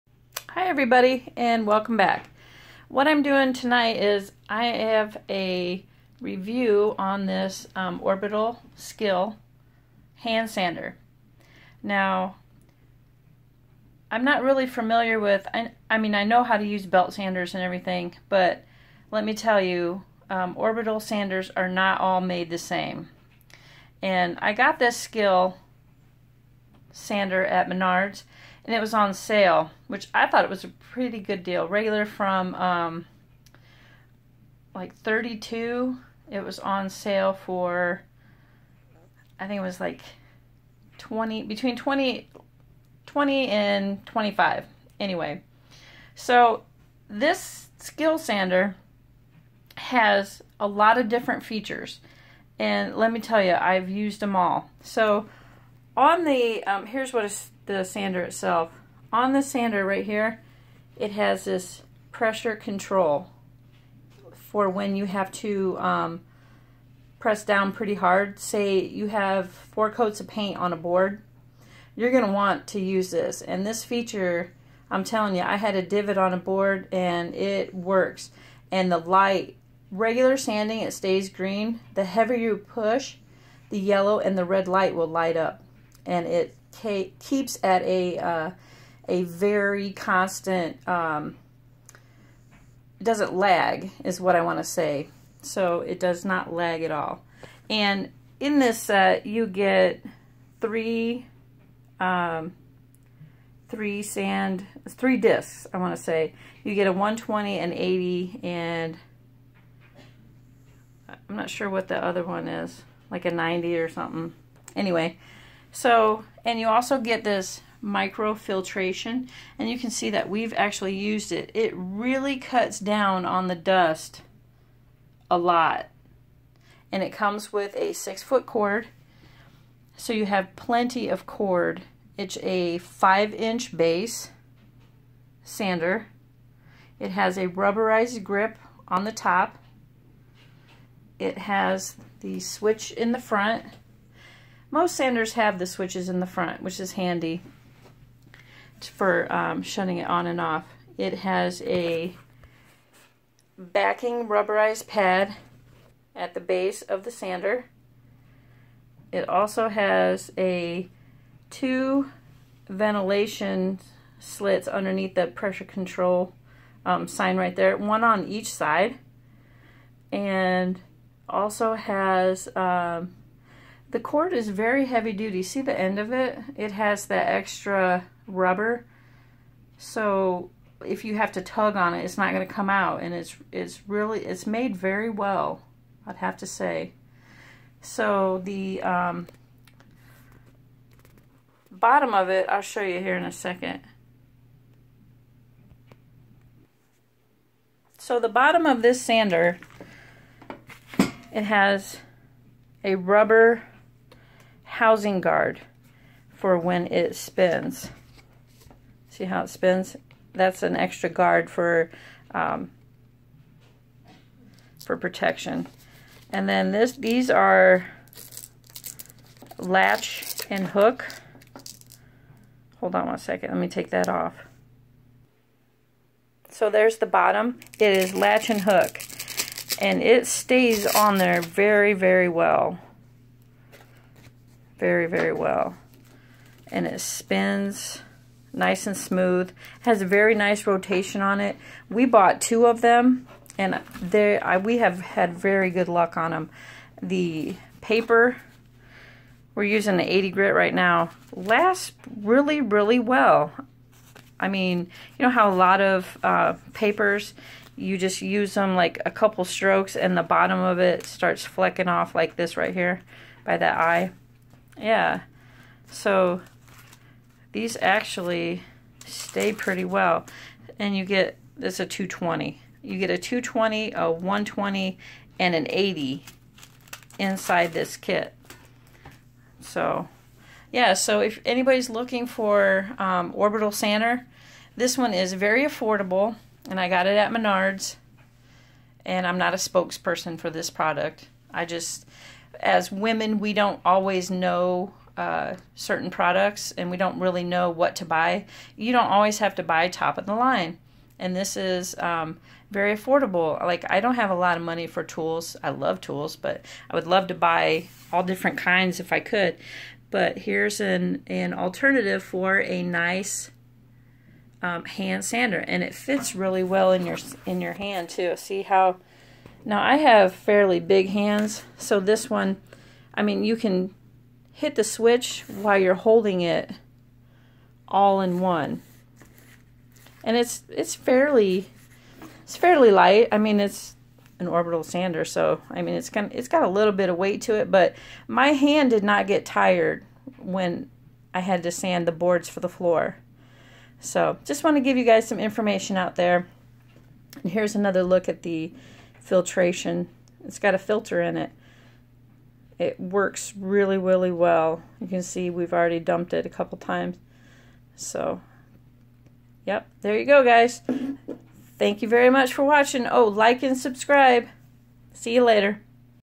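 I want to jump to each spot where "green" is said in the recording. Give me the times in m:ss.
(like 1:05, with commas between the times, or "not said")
1:21.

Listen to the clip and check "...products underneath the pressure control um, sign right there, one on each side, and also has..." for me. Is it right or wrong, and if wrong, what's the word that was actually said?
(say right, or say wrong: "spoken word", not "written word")
wrong: "slits", not "products".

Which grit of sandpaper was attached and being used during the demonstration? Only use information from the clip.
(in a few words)
80 grit.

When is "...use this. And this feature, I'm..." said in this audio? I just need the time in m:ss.
1:12.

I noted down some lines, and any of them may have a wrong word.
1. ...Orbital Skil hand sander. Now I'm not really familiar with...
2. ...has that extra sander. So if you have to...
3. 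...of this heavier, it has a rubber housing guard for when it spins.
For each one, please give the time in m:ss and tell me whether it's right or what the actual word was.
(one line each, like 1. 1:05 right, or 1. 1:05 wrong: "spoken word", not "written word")
1. 0:08 right
2. 2:56 wrong: "rubber", not "sander"
3. 3:18 wrong: "sander", not "heavier".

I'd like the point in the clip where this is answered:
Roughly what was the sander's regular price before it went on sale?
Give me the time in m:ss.
0:34.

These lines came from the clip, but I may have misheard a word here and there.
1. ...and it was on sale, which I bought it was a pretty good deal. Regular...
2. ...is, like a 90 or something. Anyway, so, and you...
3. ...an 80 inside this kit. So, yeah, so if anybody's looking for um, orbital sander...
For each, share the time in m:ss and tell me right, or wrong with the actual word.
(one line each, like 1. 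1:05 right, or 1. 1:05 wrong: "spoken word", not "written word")
1. 0:28 wrong: "thought", not "bought"
2. 1:52 right
3. 4:35 right.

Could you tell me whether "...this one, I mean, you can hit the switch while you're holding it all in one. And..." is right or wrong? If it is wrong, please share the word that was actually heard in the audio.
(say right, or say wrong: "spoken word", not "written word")
right.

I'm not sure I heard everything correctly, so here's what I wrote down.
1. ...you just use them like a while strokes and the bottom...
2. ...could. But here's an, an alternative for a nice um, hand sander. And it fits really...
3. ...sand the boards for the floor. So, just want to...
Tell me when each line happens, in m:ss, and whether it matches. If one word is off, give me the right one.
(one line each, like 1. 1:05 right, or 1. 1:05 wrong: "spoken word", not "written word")
1. 4:17 wrong: "couple", not "while"
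2. 5:09 right
3. 5:41 right.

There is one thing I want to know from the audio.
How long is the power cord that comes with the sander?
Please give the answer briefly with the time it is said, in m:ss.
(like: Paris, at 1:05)
six foot, at 2:07.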